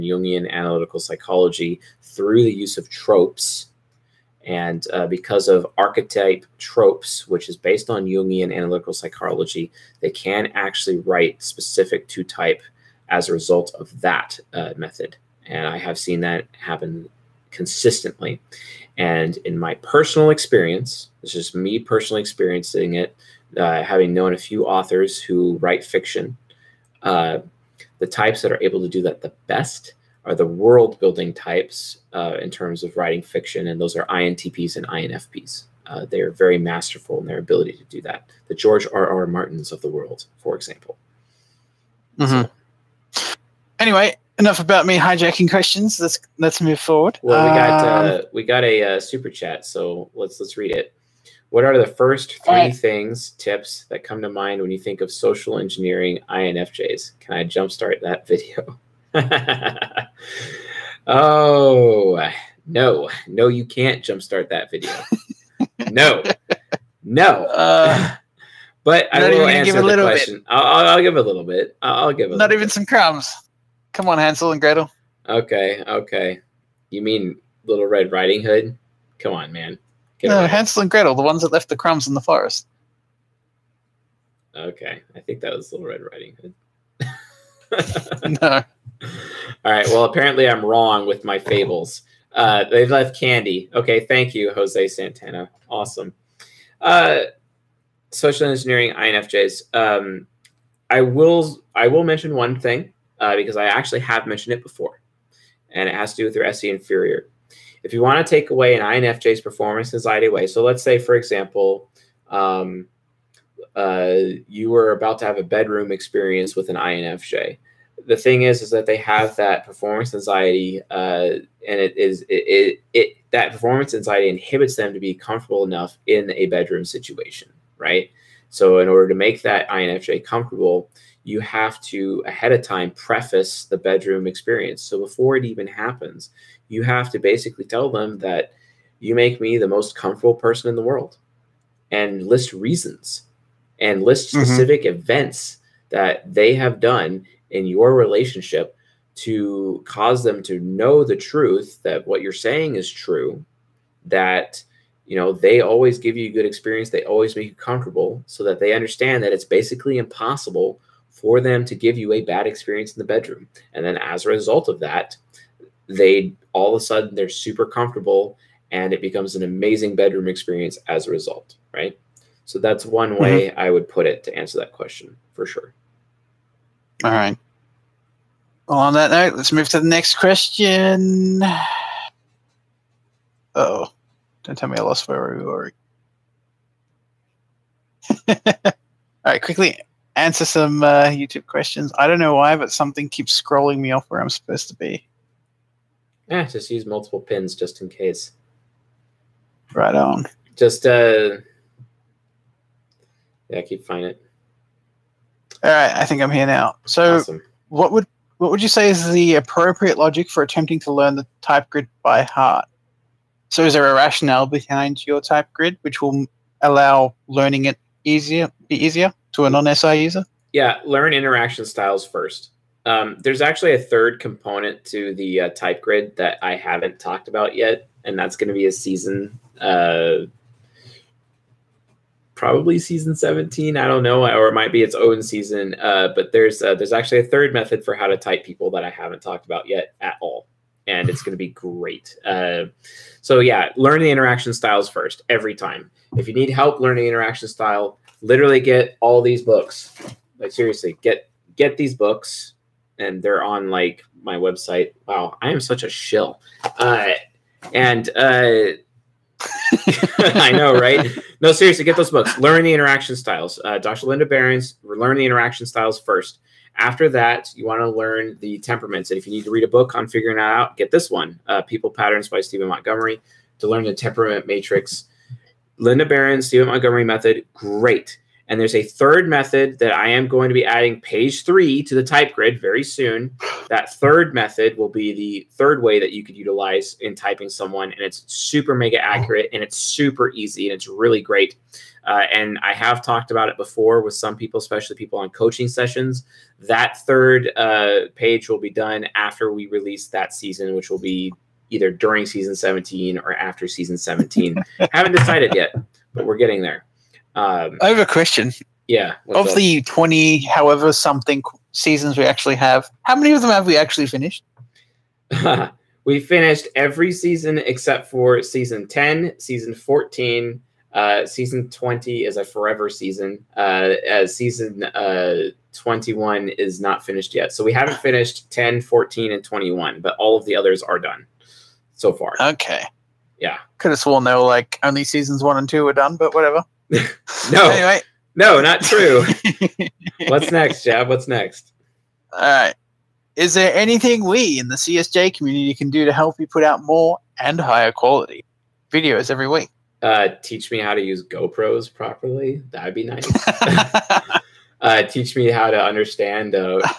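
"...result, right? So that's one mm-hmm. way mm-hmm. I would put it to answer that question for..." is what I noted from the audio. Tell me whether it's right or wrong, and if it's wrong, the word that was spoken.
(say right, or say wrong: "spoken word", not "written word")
right.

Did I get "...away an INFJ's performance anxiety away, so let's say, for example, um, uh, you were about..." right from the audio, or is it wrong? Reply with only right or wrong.
right.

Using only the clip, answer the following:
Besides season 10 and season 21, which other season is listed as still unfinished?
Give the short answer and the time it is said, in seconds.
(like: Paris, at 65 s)
Season 14, at 319 s.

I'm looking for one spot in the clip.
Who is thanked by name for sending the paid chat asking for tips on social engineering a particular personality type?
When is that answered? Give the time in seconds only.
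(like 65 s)
94 s.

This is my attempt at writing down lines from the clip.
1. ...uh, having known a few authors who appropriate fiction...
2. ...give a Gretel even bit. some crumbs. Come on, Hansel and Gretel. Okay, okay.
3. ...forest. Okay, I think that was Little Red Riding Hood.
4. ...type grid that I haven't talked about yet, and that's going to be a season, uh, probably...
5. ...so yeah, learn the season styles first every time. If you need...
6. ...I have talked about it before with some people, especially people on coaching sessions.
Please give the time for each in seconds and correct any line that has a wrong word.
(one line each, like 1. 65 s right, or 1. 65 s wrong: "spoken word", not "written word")
1. 23 s wrong: "write", not "appropriate"
2. 72 s wrong: "Not", not "Gretel"
3. 82 s right
4. 225 s right
5. 243 s wrong: "interaction", not "season"
6. 292 s right.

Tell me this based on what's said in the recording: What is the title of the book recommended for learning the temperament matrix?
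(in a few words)
People Patterns.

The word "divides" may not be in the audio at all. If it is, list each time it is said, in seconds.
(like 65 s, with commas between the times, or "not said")
not said.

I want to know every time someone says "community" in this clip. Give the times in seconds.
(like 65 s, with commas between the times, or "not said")
345 s.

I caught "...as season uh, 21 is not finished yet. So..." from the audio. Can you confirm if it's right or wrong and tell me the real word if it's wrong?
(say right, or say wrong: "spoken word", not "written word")
right.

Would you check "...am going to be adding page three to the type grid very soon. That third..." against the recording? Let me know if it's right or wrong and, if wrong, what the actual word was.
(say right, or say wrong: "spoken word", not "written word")
right.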